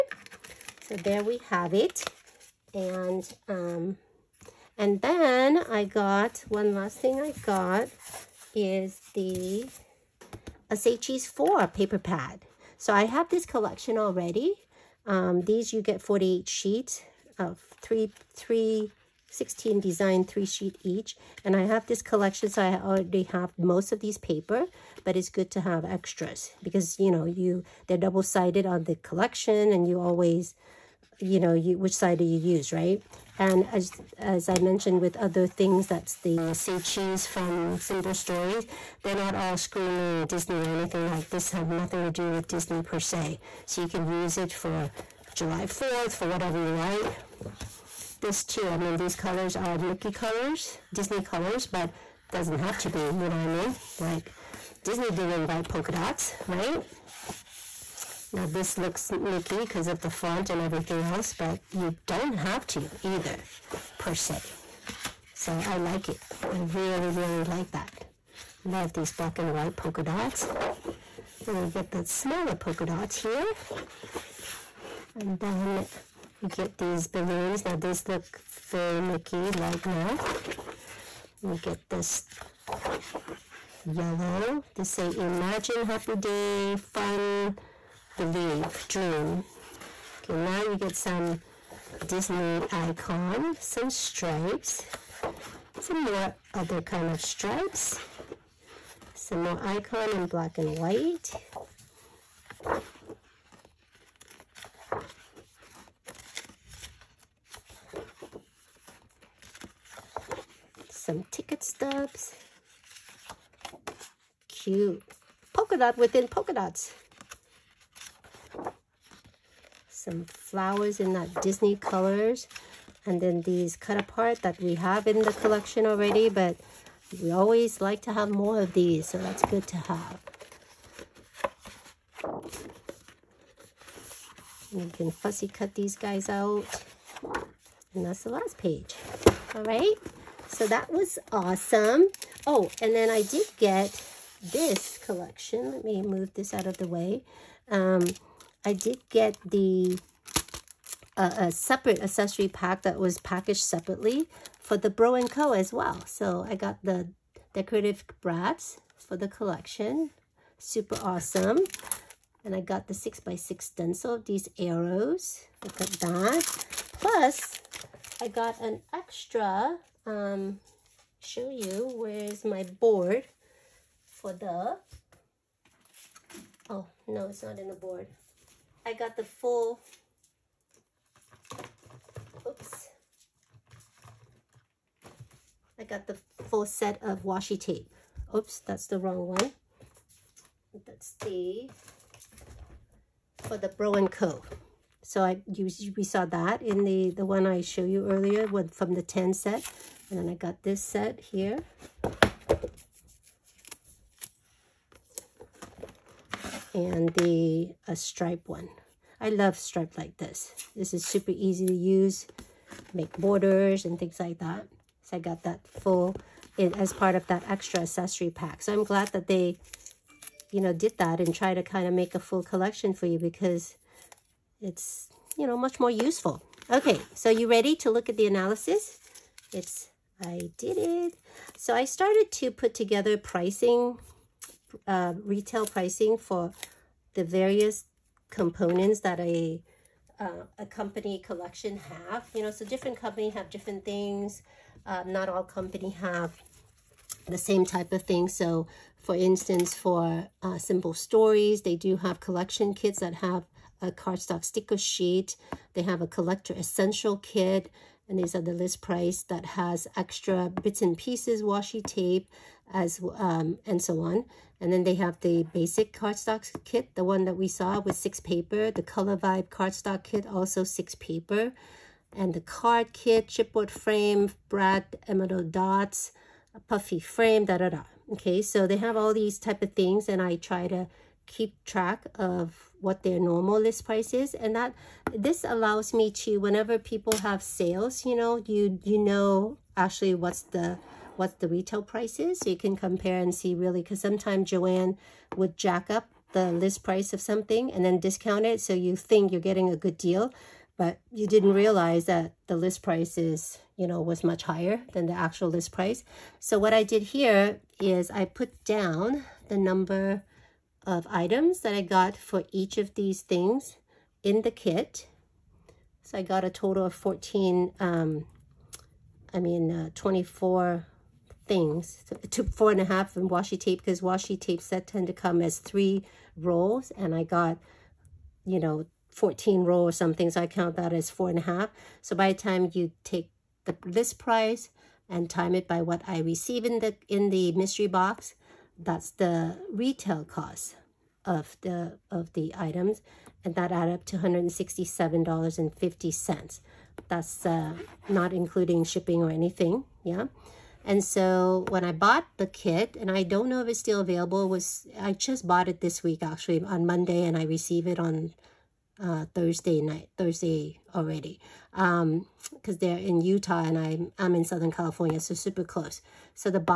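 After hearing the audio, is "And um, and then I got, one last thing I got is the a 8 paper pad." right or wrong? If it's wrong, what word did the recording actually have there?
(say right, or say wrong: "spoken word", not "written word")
wrong: "4", not "8".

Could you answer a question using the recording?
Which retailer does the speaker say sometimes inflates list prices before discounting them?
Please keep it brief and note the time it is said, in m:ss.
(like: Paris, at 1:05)
Joann, at 4:54.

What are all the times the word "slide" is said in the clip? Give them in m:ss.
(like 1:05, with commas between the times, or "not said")
not said.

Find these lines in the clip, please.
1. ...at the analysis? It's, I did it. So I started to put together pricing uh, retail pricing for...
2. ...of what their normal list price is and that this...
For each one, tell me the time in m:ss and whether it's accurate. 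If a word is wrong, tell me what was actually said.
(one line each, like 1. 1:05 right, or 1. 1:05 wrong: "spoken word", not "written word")
1. 3:48 right
2. 4:42 right.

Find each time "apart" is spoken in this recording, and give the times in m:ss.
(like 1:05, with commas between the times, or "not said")
2:03.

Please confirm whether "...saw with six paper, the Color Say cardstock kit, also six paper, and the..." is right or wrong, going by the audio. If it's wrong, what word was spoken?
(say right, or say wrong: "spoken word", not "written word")
wrong: "Vibe", not "Say".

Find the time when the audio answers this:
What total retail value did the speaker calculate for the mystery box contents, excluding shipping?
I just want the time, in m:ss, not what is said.
5:44.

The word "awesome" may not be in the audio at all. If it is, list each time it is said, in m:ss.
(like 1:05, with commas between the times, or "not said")
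2:21, 2:41.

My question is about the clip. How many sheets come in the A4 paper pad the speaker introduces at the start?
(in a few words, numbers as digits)
48.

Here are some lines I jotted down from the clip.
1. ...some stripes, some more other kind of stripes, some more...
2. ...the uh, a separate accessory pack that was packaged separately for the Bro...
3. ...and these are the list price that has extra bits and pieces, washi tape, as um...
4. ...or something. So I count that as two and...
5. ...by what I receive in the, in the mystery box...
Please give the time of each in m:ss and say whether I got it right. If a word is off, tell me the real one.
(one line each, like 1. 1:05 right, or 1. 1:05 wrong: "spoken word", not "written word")
1. 1:33 right
2. 2:29 right
3. 4:18 right
4. 5:29 wrong: "four", not "two"
5. 5:35 right.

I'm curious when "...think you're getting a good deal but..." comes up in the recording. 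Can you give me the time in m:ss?
4:58.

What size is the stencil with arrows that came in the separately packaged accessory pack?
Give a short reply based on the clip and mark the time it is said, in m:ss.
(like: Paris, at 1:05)
6x6, at 2:42.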